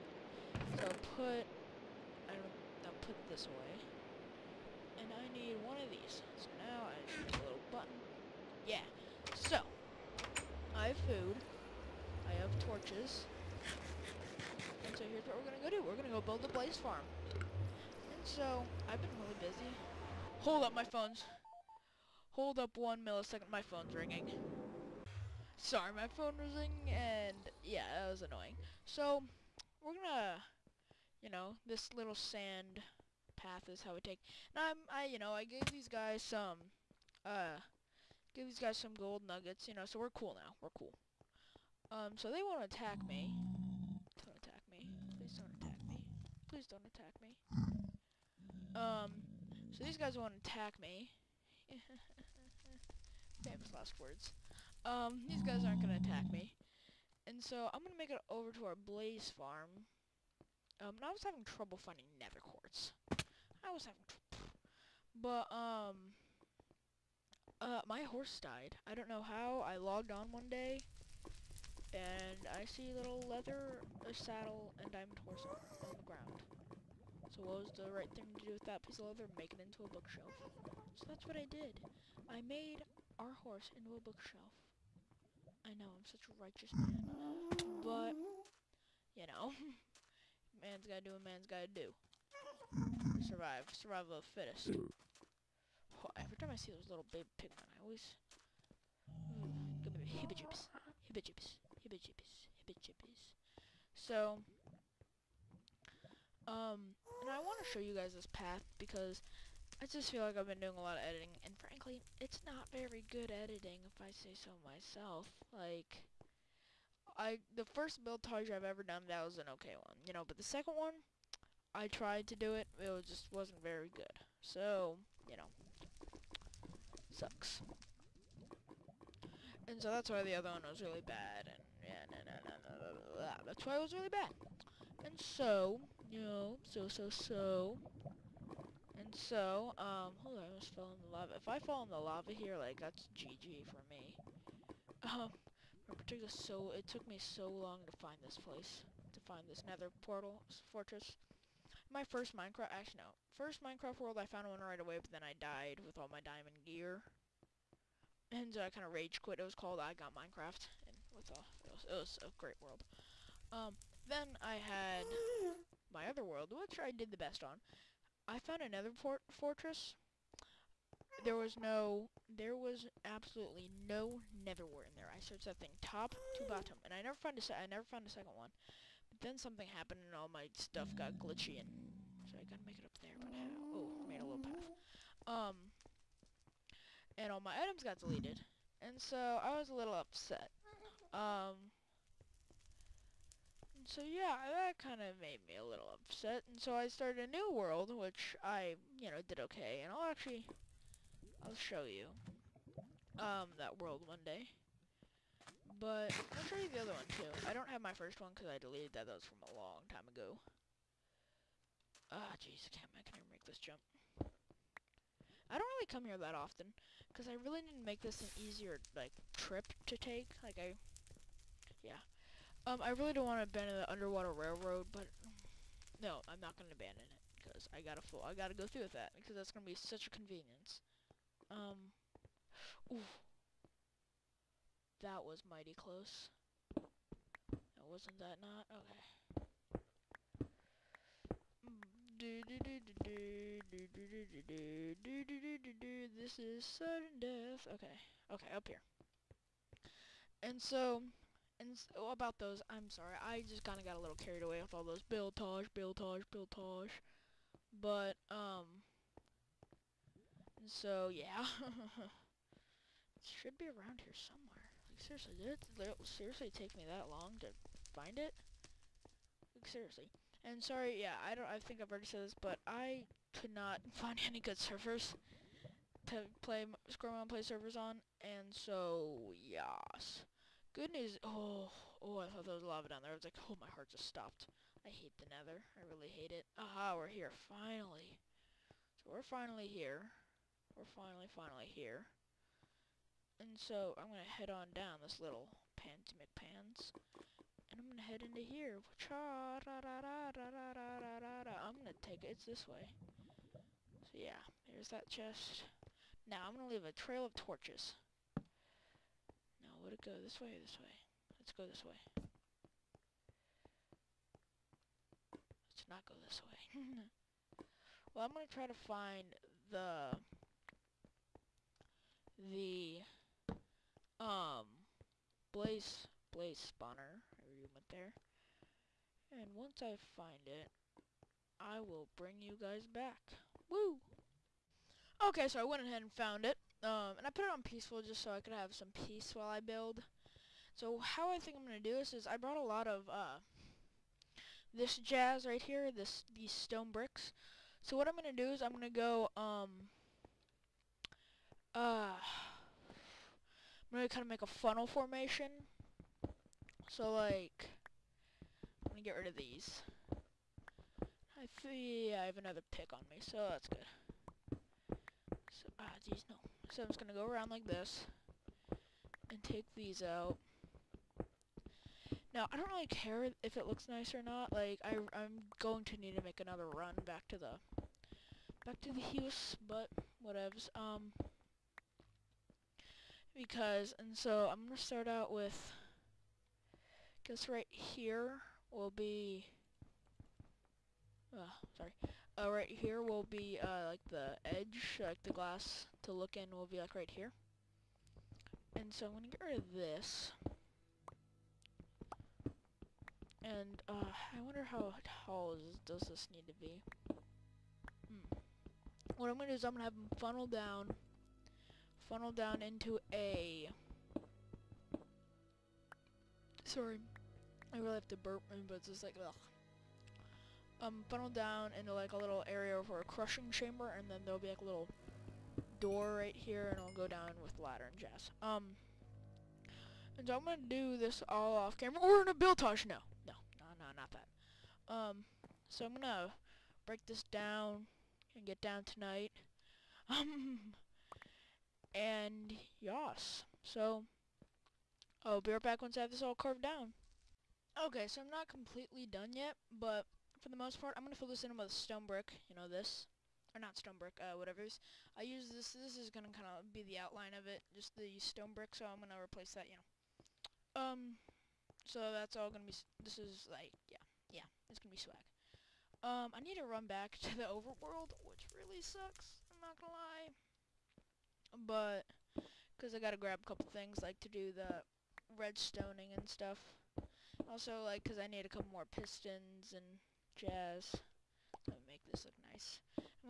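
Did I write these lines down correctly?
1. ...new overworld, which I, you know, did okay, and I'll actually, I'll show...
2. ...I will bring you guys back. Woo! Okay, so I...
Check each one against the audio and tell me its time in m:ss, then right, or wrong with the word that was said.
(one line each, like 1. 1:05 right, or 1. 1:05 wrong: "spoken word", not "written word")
1. 3:17 wrong: "world", not "overworld"
2. 5:31 right.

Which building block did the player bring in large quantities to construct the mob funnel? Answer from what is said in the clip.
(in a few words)
Stone bricks.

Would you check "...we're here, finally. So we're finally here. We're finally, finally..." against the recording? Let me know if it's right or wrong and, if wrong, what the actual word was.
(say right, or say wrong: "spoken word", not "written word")
right.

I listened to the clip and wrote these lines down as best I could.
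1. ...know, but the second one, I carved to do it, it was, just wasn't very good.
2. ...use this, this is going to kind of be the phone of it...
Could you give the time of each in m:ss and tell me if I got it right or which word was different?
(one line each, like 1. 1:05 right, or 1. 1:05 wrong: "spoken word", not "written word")
1. 2:00 wrong: "tried", not "carved"
2. 7:35 wrong: "outline", not "phone".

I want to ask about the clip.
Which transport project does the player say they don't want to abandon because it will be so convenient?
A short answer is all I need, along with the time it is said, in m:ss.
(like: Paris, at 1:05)
The underwater railroad, at 3:43.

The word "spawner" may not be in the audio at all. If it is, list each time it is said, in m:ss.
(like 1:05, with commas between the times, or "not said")
5:26.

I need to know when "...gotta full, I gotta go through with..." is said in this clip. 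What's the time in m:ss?
3:47.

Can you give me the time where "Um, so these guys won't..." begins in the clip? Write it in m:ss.
0:48.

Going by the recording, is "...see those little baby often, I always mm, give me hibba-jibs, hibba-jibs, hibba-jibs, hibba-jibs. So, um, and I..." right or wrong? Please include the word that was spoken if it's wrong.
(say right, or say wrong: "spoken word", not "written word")
wrong: "pigmen", not "often".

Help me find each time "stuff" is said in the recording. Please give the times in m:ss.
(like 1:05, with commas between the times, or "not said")
3:00, 7:56.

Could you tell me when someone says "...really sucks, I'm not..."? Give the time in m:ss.
7:48.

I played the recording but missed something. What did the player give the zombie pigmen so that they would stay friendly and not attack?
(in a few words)
Gold nuggets.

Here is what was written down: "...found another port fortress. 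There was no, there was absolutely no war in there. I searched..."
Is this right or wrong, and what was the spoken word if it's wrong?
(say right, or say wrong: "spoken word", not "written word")
right.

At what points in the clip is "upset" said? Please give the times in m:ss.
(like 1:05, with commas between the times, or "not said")
3:09, 3:15.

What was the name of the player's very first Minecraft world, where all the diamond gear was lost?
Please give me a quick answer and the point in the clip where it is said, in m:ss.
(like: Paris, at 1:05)
I Got Minecraft, at 2:39.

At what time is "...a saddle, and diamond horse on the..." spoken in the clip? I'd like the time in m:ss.
1:14.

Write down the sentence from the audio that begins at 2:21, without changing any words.
If I fall in the lava here, like, that's GG for me.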